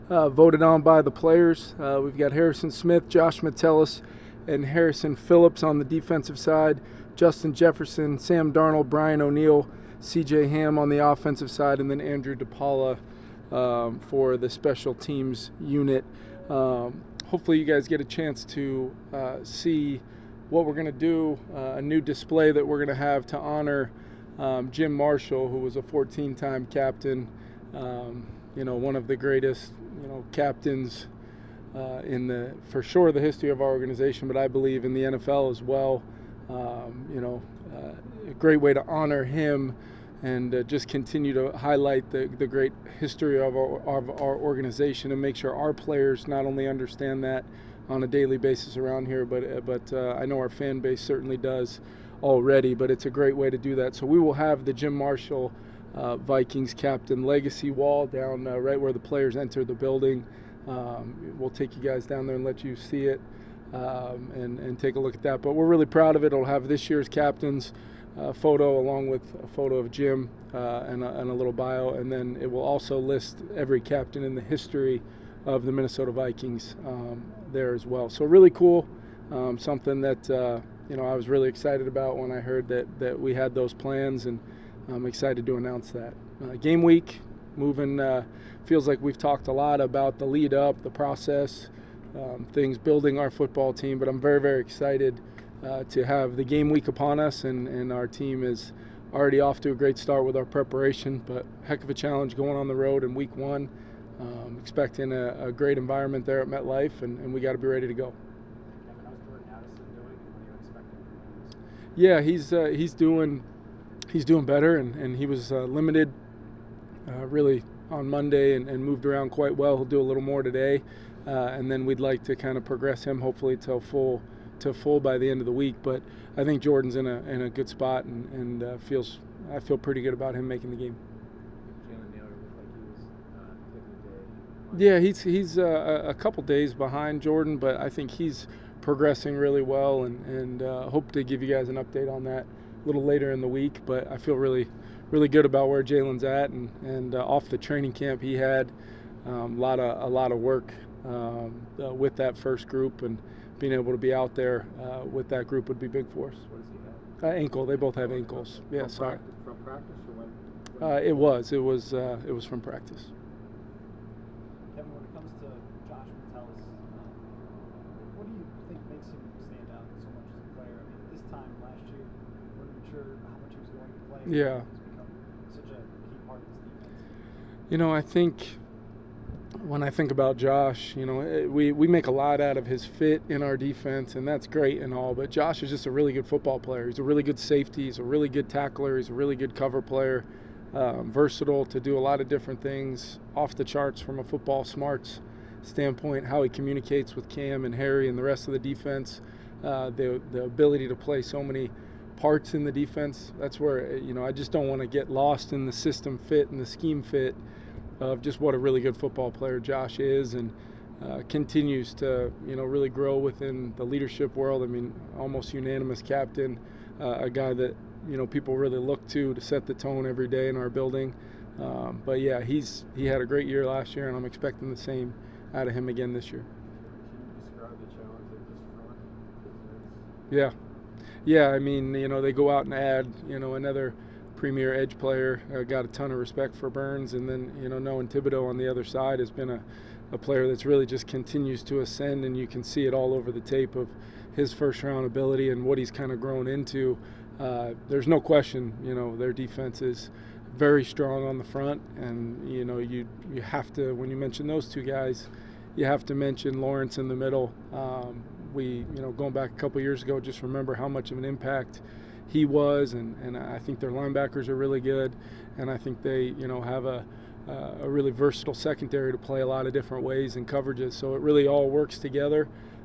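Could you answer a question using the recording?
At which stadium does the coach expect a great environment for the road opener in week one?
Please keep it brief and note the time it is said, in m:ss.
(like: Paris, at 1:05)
MetLife, at 1:46.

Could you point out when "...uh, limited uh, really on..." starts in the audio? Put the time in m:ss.
1:55.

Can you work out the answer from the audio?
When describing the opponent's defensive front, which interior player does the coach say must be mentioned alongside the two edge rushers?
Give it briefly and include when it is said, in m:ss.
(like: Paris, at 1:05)
Lawrence, at 4:16.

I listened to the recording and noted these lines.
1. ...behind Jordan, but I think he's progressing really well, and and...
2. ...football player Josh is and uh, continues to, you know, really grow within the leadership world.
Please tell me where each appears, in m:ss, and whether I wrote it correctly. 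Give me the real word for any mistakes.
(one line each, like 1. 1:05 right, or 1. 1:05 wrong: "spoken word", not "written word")
1. 2:16 right
2. 3:28 right.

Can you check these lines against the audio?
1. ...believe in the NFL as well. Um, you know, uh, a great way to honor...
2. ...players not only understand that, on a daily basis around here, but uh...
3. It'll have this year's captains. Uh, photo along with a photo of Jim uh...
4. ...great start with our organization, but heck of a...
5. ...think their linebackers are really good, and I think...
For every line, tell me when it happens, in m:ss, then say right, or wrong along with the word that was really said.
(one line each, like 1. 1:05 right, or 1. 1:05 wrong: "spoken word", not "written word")
1. 0:34 right
2. 0:45 right
3. 1:06 right
4. 1:39 wrong: "preparation", not "organization"
5. 4:23 right.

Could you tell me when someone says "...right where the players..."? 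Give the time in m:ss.
0:58.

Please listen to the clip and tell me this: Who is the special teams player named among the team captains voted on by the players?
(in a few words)
Andrew DePaola.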